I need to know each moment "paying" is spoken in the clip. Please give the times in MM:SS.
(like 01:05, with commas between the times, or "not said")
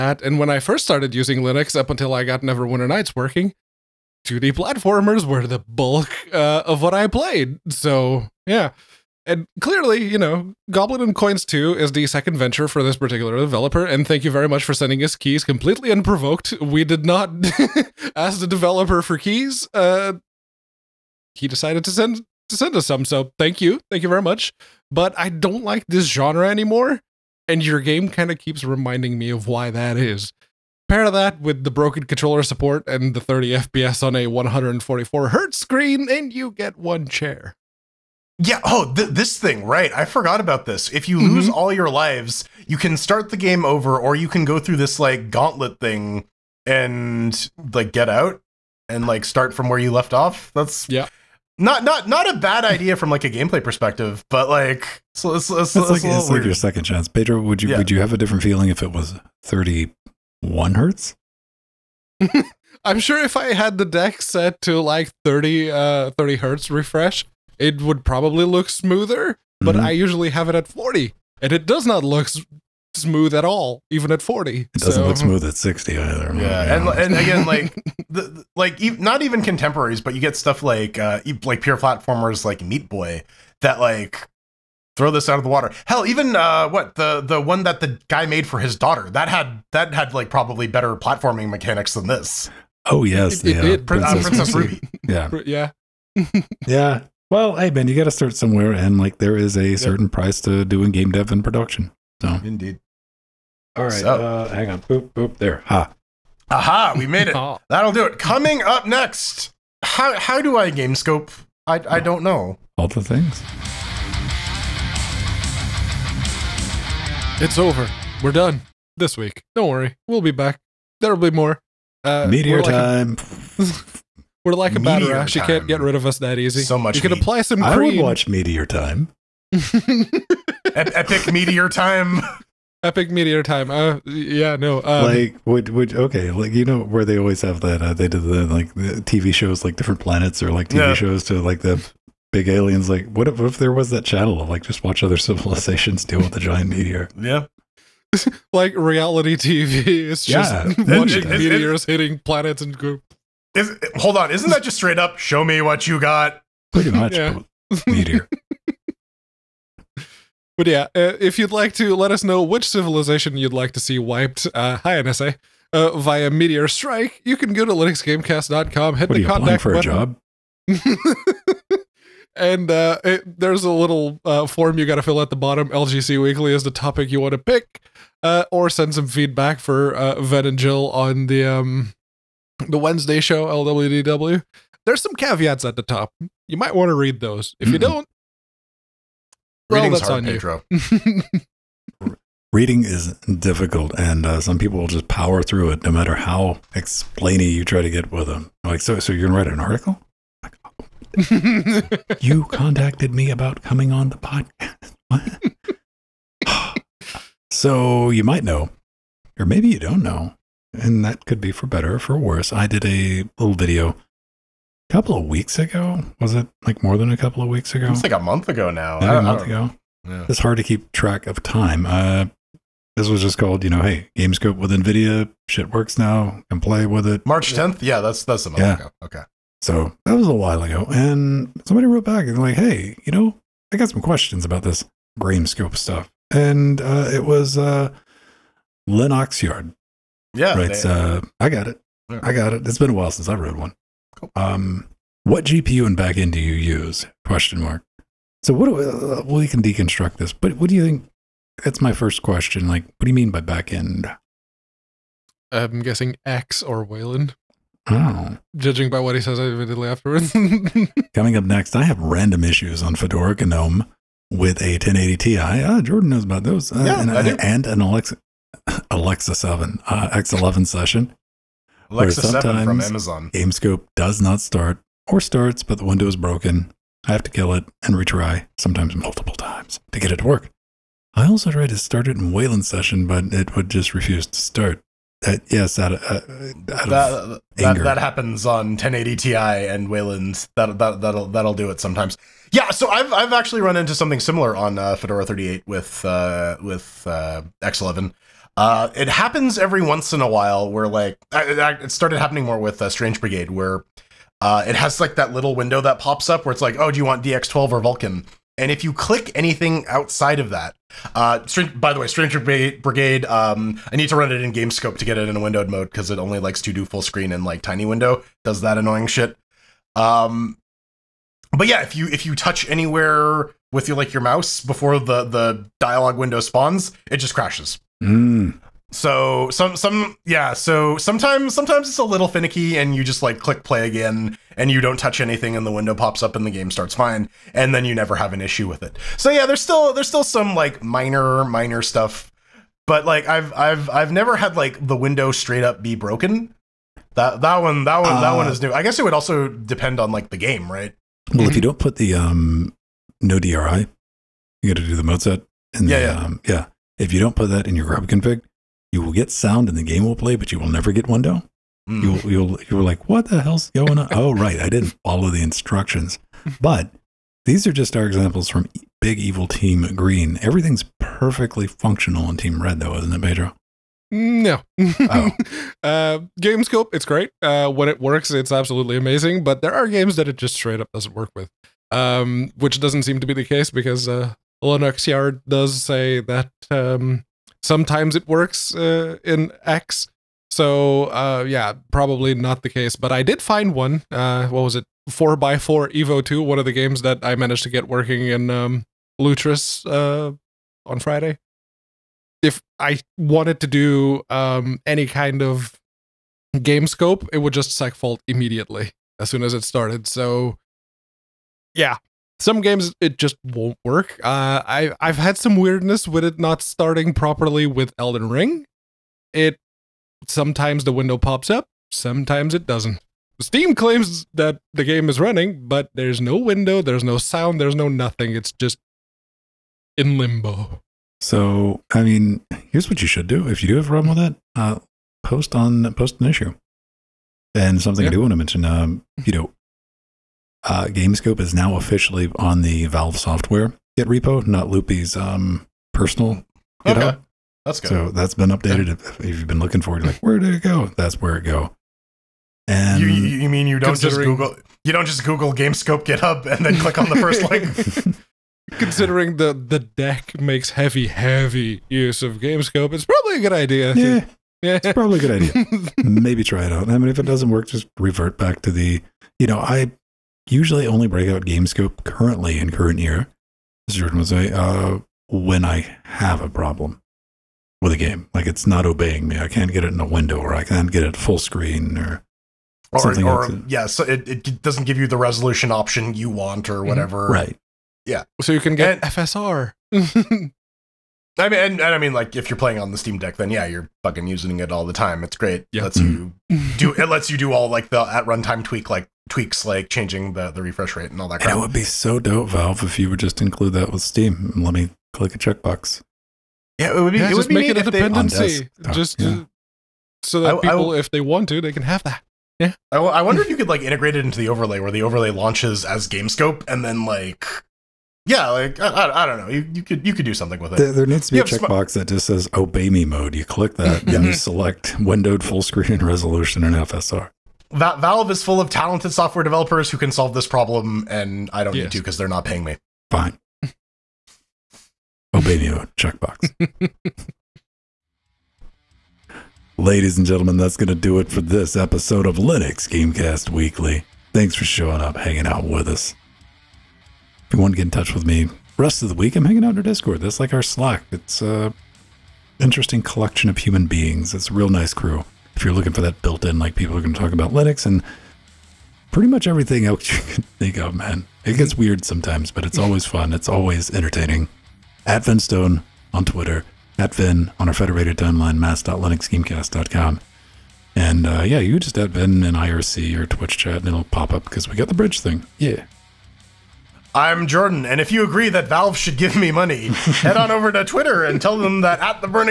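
08:52.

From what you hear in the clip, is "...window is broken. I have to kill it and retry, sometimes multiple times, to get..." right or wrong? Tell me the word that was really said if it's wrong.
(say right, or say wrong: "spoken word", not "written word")
right.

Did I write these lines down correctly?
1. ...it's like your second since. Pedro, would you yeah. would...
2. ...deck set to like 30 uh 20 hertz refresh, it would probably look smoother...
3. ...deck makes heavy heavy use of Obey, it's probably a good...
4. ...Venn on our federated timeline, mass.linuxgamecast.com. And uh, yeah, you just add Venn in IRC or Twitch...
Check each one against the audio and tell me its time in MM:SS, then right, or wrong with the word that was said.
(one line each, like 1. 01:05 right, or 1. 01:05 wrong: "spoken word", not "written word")
1. 00:56 wrong: "chance", not "since"
2. 01:03 wrong: "30", not "20"
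3. 07:39 wrong: "GameScope", not "Obey"
4. 09:27 right.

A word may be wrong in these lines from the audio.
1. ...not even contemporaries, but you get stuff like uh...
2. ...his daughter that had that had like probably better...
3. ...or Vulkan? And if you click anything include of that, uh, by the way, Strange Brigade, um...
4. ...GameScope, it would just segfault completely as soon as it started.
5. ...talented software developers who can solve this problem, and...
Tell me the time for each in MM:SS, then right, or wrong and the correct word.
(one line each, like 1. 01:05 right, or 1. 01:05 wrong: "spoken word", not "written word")
1. 01:18 right
2. 01:28 right
3. 05:07 wrong: "outside", not "include"
4. 06:46 wrong: "immediately", not "completely"
5. 08:48 right.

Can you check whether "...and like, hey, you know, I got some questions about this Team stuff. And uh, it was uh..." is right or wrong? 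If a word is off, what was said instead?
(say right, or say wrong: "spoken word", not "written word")
wrong: "GameScope", not "Team".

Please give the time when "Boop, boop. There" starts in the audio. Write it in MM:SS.
01:44.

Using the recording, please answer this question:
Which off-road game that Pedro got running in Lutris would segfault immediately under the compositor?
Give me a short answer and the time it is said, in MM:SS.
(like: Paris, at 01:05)
4x4 Evo 2, at 06:35.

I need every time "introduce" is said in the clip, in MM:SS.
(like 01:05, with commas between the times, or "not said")
not said.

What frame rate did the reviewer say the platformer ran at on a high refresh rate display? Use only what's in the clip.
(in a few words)
30 FPS.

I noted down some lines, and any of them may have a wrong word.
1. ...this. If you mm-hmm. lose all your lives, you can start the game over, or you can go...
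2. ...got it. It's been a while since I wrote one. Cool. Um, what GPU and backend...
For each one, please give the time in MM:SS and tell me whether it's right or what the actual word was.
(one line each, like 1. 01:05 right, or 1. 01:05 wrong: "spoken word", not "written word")
1. 00:40 right
2. 04:02 right.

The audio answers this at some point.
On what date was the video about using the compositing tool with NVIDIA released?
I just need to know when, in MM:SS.
03:47.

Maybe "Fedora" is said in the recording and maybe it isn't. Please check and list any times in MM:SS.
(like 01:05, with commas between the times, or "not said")
04:22, 04:54.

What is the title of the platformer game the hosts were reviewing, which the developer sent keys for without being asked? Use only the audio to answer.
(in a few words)
Goblin and Coins 2.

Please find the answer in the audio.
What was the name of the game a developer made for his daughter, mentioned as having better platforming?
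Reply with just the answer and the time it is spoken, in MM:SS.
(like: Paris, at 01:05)
Princess Ruby, at 01:34.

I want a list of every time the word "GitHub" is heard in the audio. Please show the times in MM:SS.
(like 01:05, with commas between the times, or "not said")
07:26, 07:36.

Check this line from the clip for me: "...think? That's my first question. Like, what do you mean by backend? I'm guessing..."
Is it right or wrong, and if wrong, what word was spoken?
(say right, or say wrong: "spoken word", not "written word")
right.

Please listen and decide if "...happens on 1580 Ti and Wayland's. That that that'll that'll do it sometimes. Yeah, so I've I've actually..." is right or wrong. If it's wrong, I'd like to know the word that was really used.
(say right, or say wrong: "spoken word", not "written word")
wrong: "1080", not "1580".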